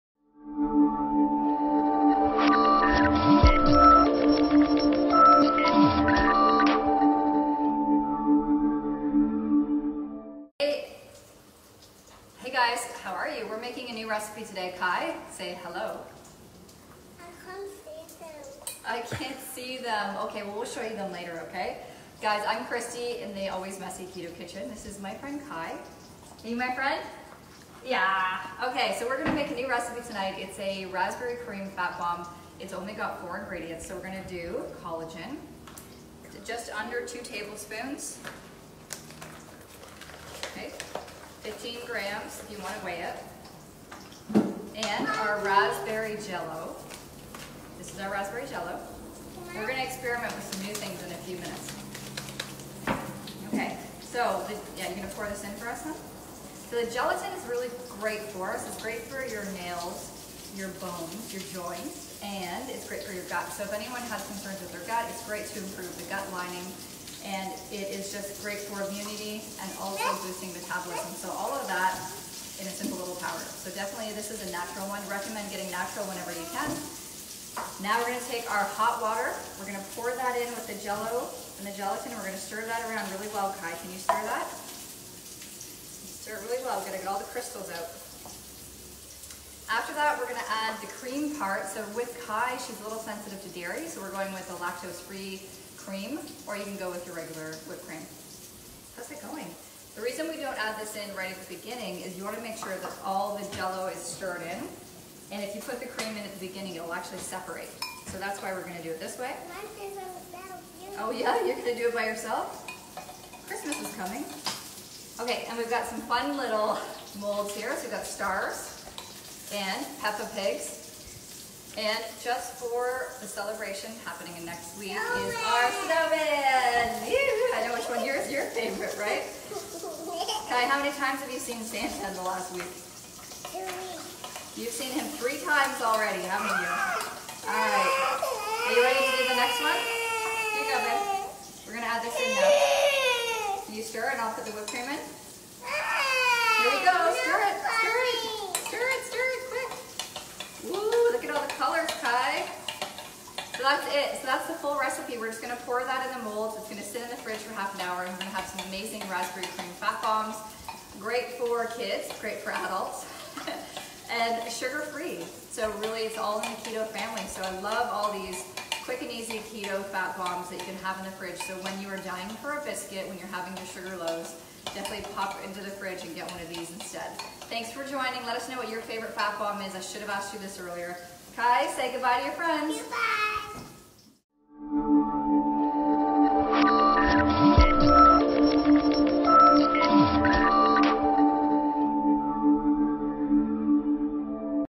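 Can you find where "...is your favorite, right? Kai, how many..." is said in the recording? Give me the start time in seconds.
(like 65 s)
128 s.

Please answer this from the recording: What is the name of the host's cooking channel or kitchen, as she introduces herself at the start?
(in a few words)
Always Messy Keto Kitchen.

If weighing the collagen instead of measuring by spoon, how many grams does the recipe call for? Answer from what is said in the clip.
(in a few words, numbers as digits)
15 grams.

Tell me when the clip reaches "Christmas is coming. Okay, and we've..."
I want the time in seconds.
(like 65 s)
113 s.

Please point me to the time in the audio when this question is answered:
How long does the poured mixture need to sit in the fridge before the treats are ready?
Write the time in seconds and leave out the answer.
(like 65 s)
157 s.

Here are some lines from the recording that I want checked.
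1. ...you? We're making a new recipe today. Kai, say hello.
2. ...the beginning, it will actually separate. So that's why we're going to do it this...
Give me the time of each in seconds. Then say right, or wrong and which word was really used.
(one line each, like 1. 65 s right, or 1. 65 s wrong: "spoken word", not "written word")
1. 13 s right
2. 106 s right.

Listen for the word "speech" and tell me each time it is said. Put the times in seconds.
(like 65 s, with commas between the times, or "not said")
not said.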